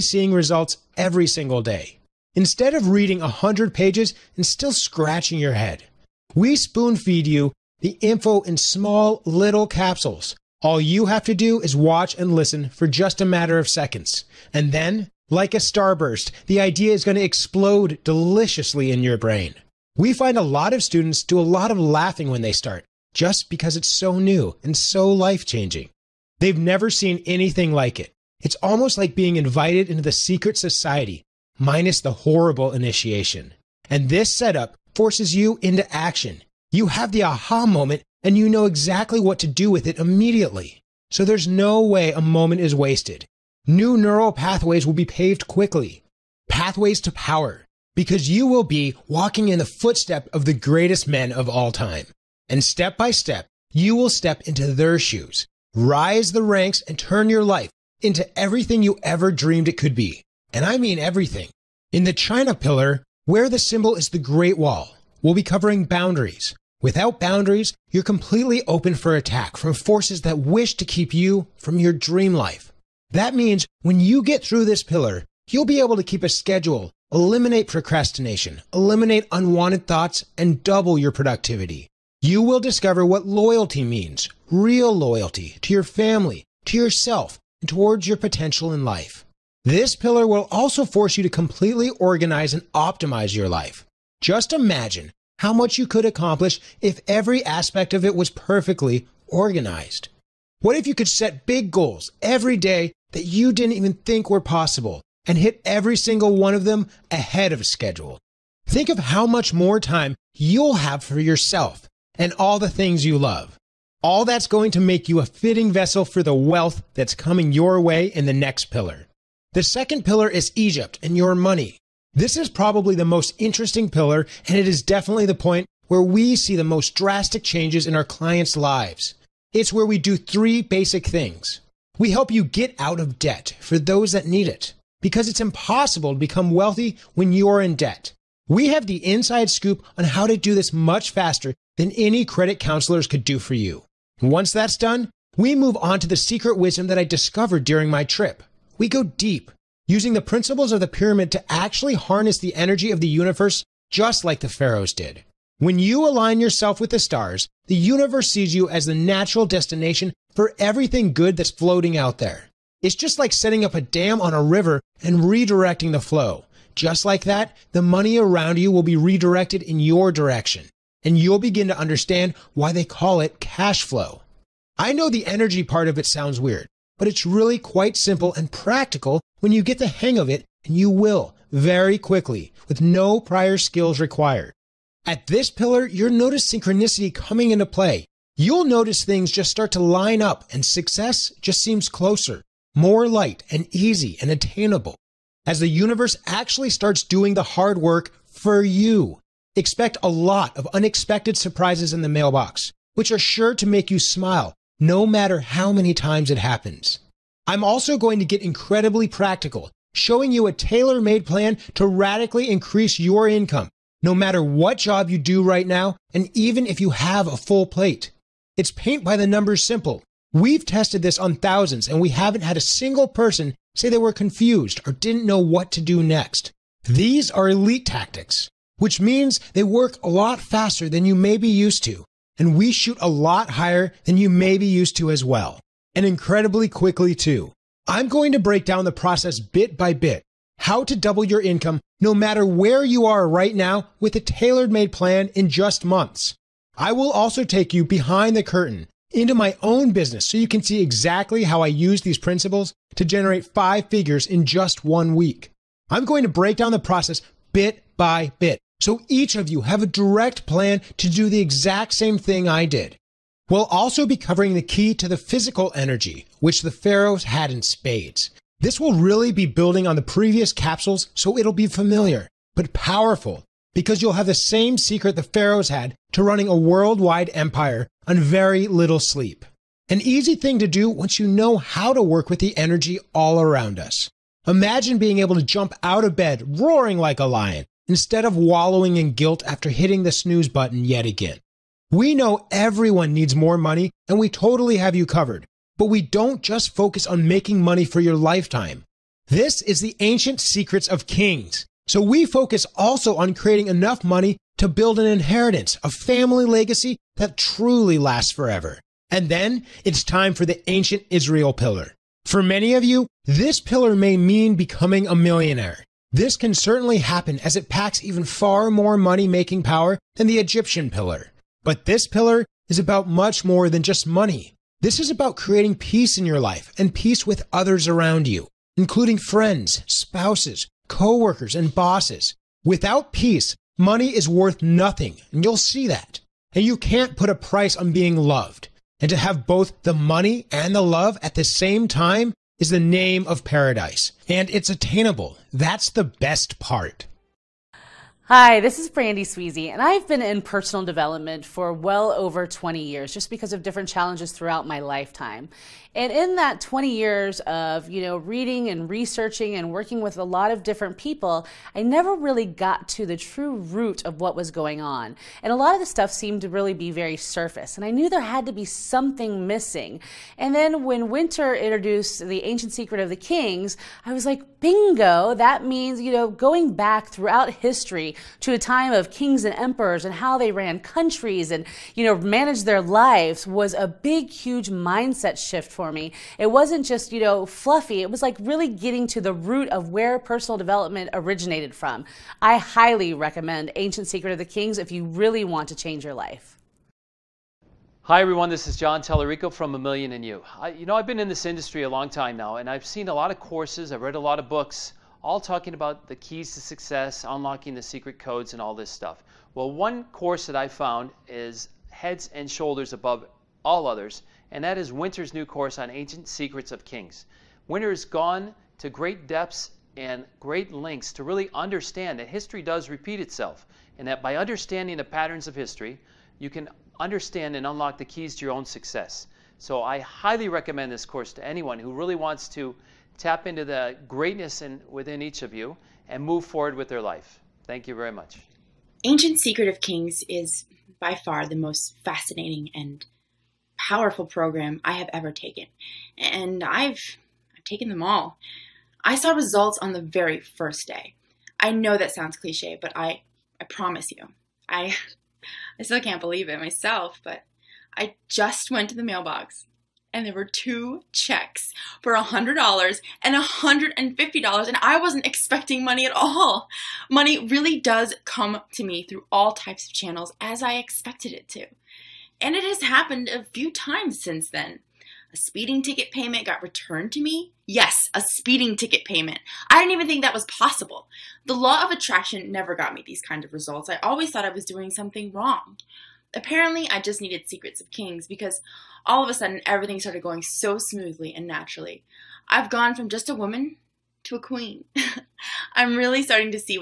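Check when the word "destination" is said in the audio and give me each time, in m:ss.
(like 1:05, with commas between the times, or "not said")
2:39.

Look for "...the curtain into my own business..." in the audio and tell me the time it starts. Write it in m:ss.
4:08.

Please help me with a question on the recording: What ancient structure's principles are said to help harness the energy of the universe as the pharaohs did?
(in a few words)
The pyramid.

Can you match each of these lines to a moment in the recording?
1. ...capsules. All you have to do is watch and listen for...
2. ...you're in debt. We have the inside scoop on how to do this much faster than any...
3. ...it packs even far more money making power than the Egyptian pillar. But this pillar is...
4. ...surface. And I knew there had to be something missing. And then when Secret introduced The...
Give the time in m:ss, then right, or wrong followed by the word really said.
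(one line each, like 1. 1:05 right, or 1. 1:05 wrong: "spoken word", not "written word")
1. 0:09 right
2. 2:17 right
3. 5:17 right
4. 6:07 wrong: "Winter", not "Secret".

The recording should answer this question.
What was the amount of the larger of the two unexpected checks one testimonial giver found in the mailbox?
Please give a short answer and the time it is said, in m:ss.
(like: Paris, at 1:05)
$150, at 7:43.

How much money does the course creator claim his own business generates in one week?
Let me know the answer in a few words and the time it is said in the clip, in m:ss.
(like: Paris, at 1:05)
Five figures, at 4:13.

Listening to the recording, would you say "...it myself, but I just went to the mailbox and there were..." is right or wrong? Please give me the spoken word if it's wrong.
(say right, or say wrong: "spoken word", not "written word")
right.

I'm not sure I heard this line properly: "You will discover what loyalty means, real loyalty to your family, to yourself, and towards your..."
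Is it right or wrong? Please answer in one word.
right.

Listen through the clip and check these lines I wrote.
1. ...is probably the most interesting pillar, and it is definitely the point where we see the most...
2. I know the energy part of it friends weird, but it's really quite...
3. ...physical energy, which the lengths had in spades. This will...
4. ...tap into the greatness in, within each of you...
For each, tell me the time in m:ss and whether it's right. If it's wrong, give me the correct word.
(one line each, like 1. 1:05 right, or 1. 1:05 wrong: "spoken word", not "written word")
1. 2:02 right
2. 2:54 wrong: "sounds", not "friends"
3. 4:25 wrong: "pharaohs", not "lengths"
4. 7:13 right.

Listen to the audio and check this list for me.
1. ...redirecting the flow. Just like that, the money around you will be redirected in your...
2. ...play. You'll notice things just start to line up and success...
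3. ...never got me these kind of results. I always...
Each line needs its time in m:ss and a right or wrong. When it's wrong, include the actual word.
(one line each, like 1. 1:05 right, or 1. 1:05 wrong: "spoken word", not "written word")
1. 2:45 right
2. 3:07 right
3. 8:02 right.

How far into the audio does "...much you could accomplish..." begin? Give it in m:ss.
1:35.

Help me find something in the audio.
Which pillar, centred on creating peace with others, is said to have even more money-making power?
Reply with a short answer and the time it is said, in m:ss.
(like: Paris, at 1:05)
Ancient Israel, at 5:10.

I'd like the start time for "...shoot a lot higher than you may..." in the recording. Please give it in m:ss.
3:52.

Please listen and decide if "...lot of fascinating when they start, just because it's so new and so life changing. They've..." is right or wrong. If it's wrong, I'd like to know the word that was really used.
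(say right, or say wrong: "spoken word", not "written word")
wrong: "laughing", not "fascinating".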